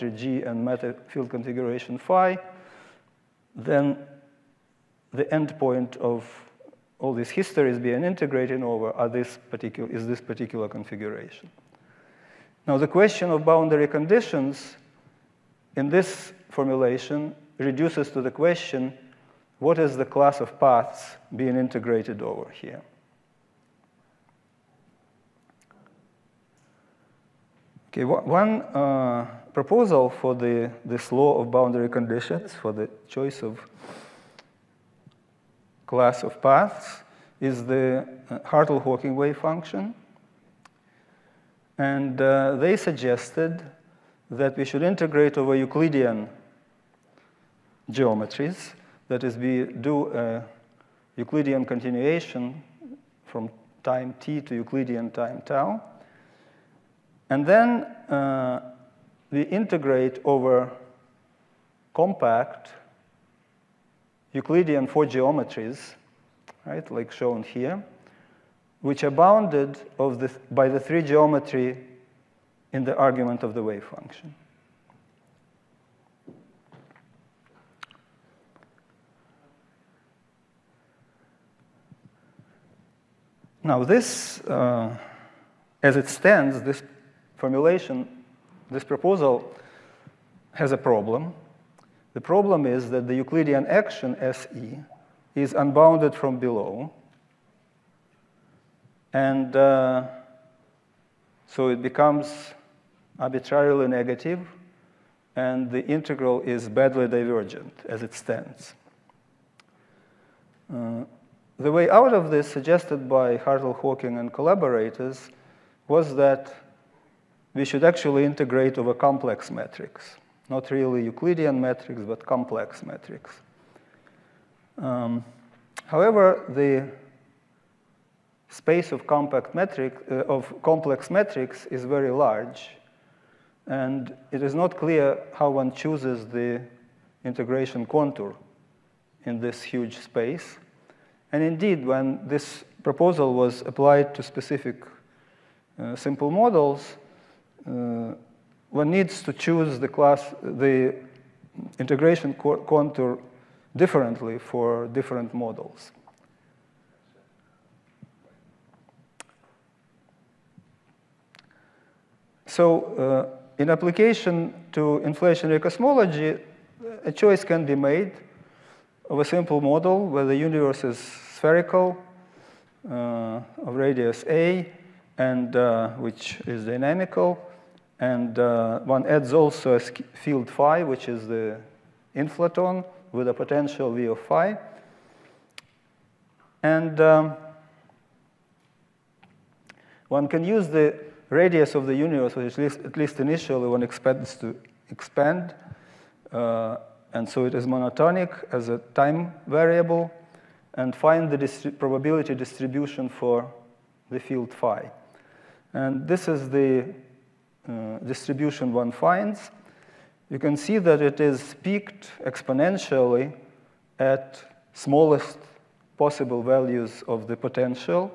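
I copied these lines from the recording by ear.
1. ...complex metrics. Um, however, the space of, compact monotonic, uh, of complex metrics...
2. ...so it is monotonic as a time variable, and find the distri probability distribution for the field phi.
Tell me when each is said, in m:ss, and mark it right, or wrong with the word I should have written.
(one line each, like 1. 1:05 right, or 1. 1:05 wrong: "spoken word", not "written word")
1. 2:02 wrong: "metric", not "monotonic"
2. 3:17 right.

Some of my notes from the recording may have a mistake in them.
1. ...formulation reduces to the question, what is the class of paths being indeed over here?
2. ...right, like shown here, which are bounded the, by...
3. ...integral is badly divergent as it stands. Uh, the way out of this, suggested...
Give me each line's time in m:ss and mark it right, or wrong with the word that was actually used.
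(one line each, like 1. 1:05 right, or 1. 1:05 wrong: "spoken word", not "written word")
1. 0:16 wrong: "integrated", not "indeed"
2. 1:06 right
3. 1:45 right.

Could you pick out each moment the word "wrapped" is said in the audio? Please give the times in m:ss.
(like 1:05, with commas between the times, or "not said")
not said.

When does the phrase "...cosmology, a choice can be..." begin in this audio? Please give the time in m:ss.
2:45.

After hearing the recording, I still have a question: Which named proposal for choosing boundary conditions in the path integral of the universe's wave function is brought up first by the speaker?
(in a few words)
Hartle-Hawking wave function.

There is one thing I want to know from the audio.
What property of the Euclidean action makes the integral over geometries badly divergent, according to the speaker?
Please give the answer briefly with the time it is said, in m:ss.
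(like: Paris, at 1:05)
Unbounded from below, at 1:35.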